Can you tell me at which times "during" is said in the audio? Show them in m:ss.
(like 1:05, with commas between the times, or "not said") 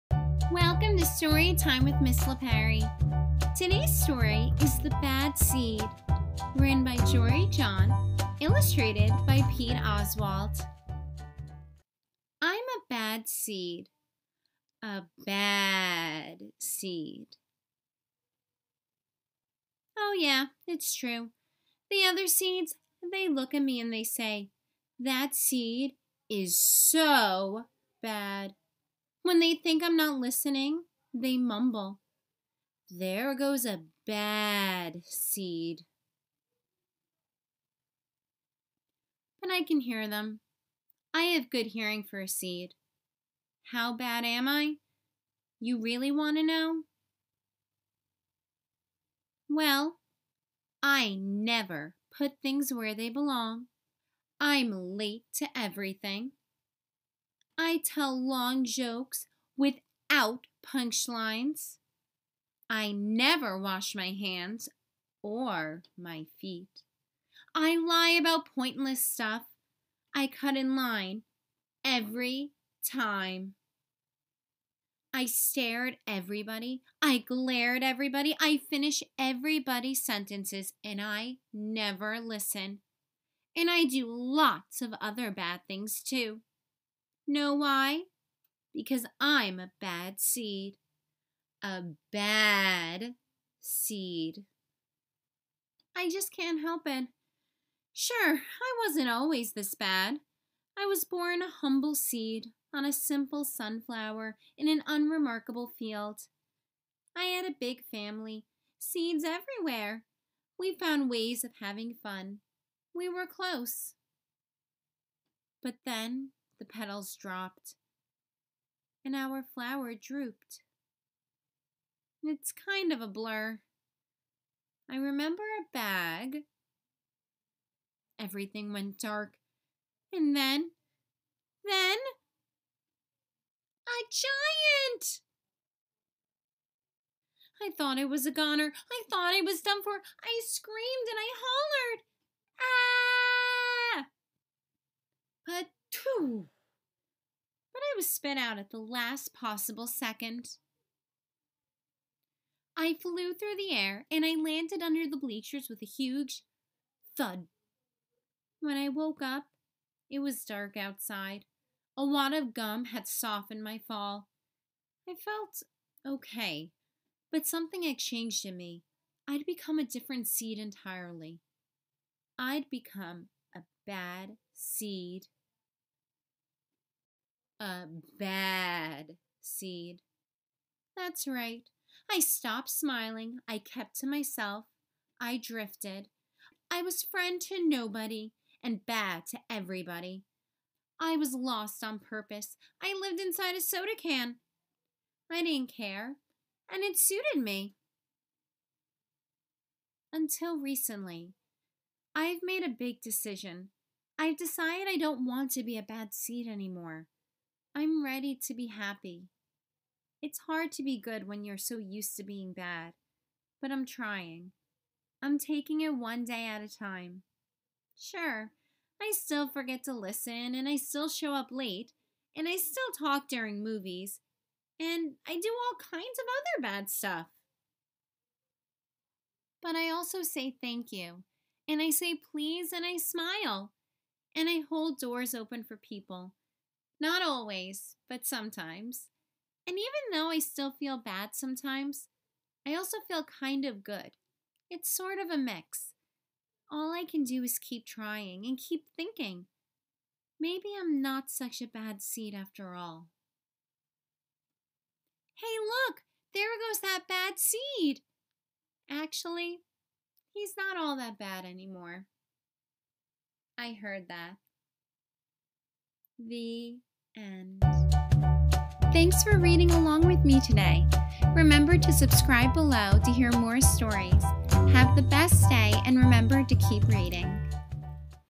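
3:43.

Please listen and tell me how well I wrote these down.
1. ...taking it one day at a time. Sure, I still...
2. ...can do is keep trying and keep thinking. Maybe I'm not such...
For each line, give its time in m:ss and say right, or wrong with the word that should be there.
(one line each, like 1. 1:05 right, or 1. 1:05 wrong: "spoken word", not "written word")
1. 3:35 right
2. 4:07 right.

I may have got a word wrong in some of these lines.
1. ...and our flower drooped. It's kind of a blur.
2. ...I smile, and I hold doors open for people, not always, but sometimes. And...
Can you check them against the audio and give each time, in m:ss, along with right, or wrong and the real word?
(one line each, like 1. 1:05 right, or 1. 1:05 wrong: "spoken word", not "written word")
1. 1:59 right
2. 3:52 right.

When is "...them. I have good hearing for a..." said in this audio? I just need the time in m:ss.
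0:40.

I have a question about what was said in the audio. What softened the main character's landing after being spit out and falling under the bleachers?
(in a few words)
A wad of gum.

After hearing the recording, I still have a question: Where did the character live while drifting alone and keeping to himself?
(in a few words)
inside a soda can.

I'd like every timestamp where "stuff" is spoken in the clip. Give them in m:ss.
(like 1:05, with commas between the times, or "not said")
1:09, 3:46.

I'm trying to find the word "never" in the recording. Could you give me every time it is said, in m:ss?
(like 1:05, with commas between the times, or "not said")
0:51, 1:02, 1:21.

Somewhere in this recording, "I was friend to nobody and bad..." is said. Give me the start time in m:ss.
3:06.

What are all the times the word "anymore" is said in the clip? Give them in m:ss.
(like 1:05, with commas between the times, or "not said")
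3:26, 4:21.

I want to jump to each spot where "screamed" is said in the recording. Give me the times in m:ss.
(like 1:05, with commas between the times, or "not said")
2:20.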